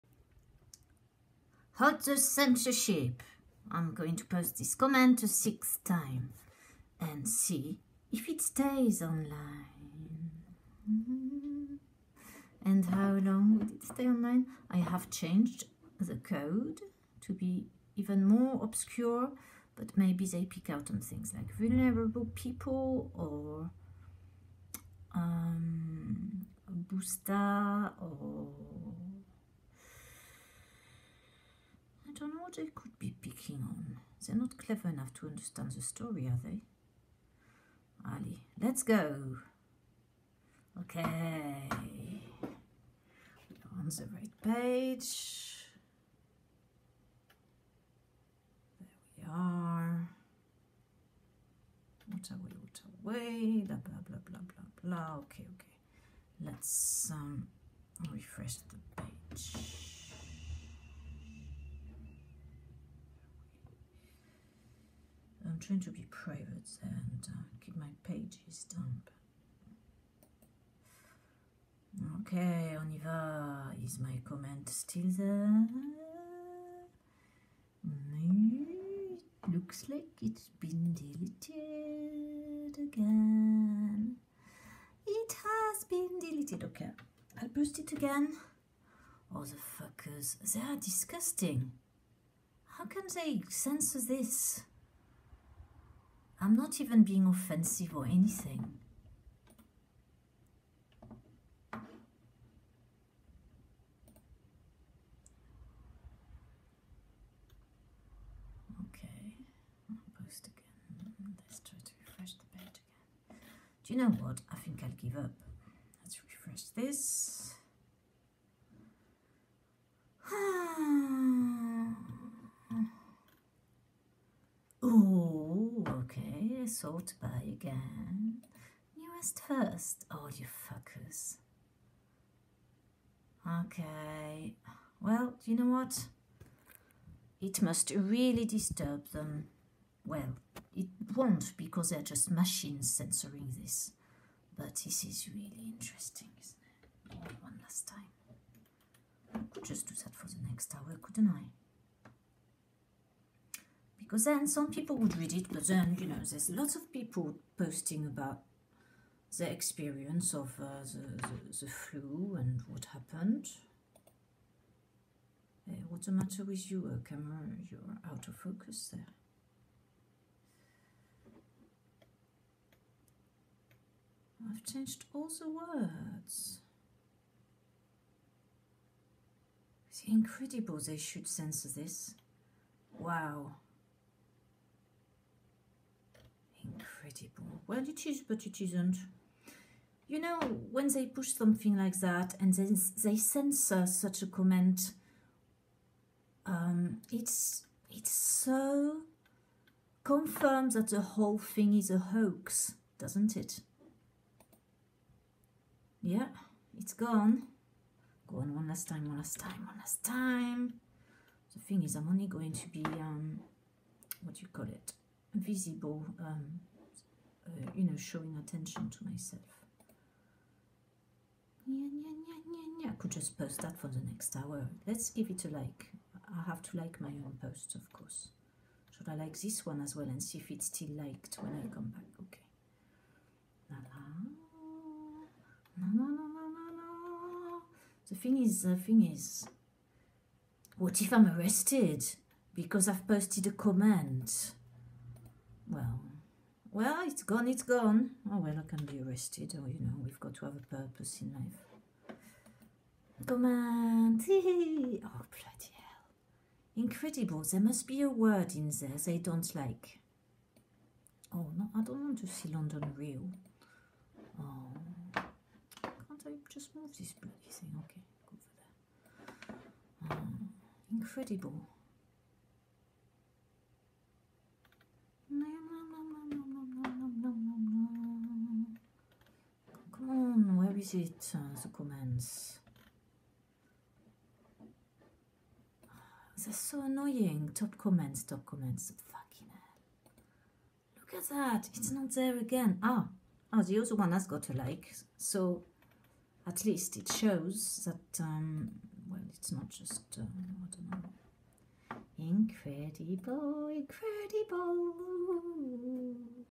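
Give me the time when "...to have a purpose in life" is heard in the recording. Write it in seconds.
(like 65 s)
250 s.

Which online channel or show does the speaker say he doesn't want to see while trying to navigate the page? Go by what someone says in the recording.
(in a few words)
London Real.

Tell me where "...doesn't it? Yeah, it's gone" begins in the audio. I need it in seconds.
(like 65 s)
202 s.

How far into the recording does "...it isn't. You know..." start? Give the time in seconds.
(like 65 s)
188 s.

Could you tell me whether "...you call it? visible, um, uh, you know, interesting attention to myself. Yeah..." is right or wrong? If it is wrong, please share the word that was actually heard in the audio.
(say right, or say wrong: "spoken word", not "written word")
wrong: "showing", not "interesting".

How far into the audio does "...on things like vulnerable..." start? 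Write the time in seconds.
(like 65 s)
20 s.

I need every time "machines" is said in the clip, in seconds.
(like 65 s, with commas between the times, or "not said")
142 s.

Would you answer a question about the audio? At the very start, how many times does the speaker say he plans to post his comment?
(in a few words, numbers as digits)
6.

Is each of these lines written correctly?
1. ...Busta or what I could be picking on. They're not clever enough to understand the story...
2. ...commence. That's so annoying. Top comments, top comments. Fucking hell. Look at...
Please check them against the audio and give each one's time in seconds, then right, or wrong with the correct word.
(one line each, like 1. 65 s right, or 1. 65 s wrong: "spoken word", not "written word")
1. 26 s right
2. 281 s right.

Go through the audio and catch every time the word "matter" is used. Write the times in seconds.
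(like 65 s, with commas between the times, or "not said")
166 s.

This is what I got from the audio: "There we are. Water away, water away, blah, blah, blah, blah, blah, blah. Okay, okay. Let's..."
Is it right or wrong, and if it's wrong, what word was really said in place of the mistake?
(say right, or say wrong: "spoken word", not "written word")
right.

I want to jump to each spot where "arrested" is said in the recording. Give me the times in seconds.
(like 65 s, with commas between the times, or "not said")
241 s, 249 s.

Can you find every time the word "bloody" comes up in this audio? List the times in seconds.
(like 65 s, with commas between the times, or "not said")
254 s, 267 s.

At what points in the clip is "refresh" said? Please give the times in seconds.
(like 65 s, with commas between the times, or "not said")
58 s, 112 s, 116 s.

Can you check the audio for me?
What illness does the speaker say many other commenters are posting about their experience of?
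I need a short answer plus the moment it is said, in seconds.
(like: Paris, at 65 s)
Flu, at 161 s.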